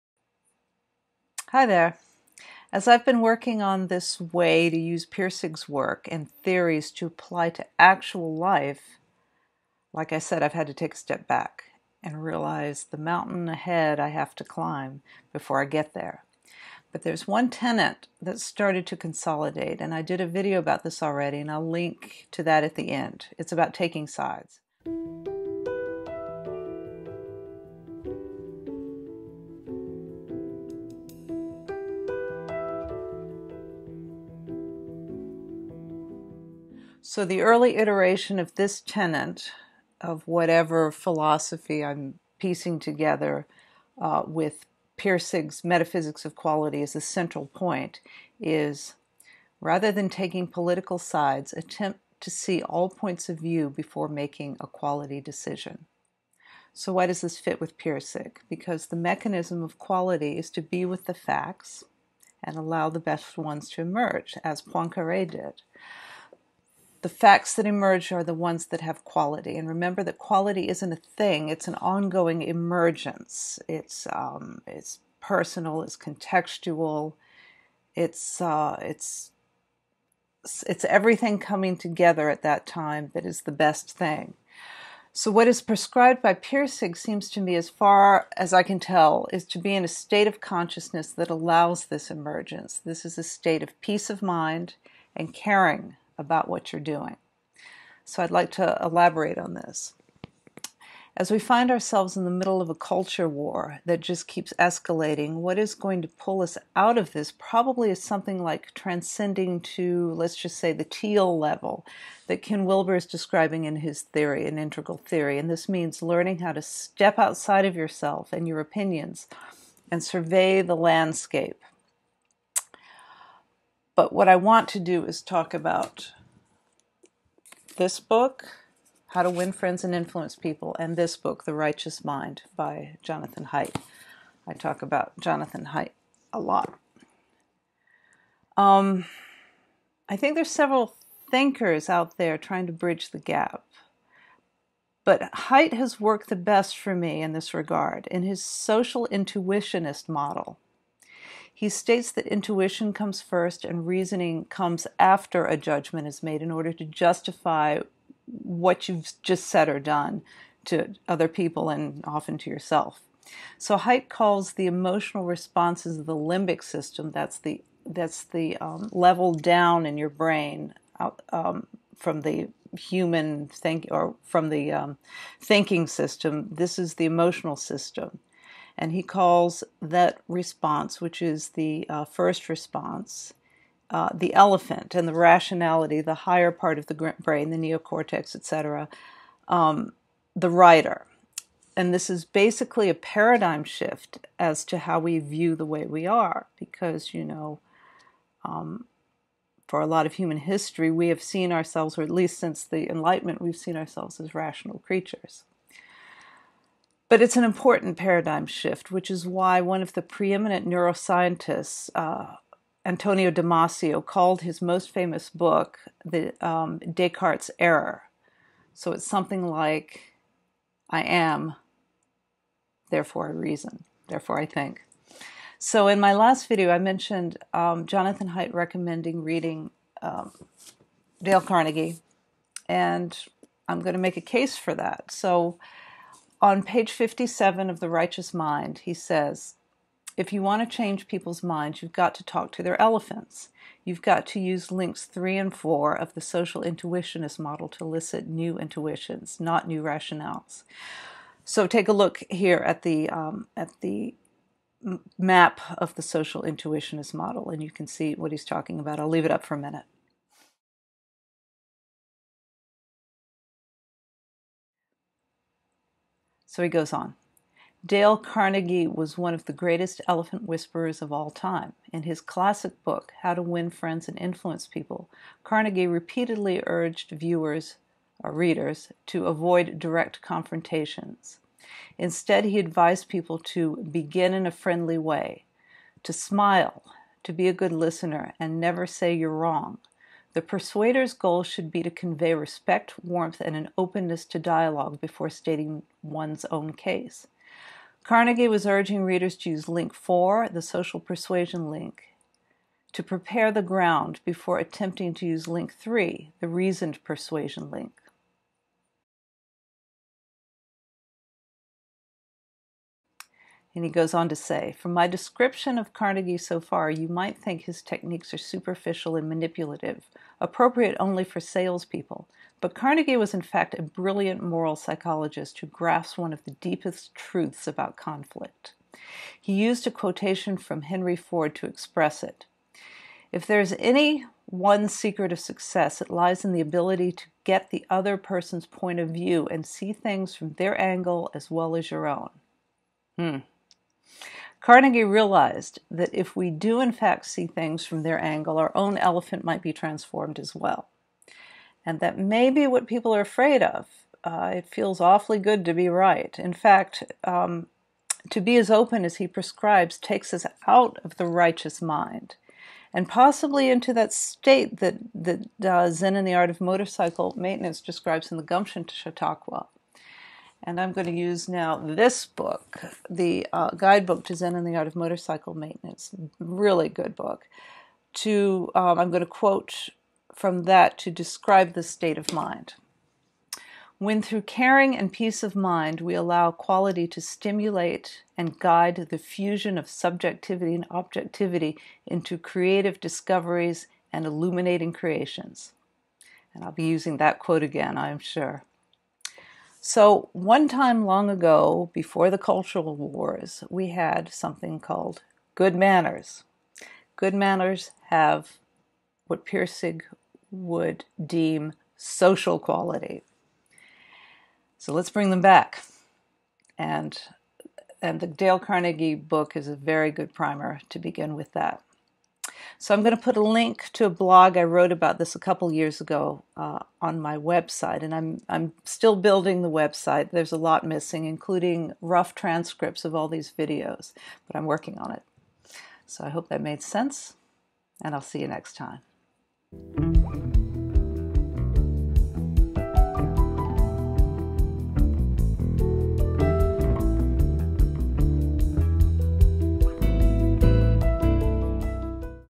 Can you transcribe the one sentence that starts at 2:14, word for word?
I talk about Jonathan Haidt a lot.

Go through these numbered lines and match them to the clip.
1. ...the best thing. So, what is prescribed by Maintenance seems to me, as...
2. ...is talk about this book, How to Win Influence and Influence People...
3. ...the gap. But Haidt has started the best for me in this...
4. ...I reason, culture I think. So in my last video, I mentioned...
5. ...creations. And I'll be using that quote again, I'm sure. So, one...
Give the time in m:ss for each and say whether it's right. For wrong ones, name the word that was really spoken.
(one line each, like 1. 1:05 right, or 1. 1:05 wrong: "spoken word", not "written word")
1. 1:23 wrong: "Pirsig", not "Maintenance"
2. 2:05 wrong: "Friends", not "Influence"
3. 2:23 wrong: "worked", not "started"
4. 3:43 wrong: "therefore", not "culture"
5. 6:34 right.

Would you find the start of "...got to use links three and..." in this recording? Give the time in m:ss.
4:04.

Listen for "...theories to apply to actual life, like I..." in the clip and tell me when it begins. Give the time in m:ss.
0:06.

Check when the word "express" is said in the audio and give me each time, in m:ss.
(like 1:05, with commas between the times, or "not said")
5:31.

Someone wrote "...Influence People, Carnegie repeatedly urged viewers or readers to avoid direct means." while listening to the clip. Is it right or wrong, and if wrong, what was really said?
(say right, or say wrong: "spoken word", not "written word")
wrong: "confrontations", not "means".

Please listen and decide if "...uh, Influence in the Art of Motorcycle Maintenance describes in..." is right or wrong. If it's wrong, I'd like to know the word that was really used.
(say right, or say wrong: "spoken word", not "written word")
wrong: "Zen", not "Influence".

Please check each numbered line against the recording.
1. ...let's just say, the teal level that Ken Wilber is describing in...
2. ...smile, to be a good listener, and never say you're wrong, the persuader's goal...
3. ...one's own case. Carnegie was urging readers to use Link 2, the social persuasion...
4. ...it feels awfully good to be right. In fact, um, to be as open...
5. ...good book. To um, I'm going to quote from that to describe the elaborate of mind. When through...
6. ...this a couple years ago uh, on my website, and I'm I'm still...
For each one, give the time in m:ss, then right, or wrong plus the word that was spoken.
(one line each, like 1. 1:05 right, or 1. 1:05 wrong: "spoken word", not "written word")
1. 1:50 right
2. 4:46 right
3. 4:56 wrong: "4", not "2"
4. 5:54 right
5. 6:16 wrong: "state", not "elaborate"
6. 7:05 right.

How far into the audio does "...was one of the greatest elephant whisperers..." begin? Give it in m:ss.
4:28.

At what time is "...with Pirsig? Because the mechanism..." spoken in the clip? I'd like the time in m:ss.
0:57.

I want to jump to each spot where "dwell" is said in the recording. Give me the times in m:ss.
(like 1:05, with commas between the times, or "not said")
not said.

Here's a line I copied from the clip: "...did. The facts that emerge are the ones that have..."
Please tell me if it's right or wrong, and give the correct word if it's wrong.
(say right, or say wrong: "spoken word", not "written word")
right.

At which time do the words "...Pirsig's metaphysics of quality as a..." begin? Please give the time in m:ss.
0:44.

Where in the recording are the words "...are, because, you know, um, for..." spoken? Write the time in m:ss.
3:16.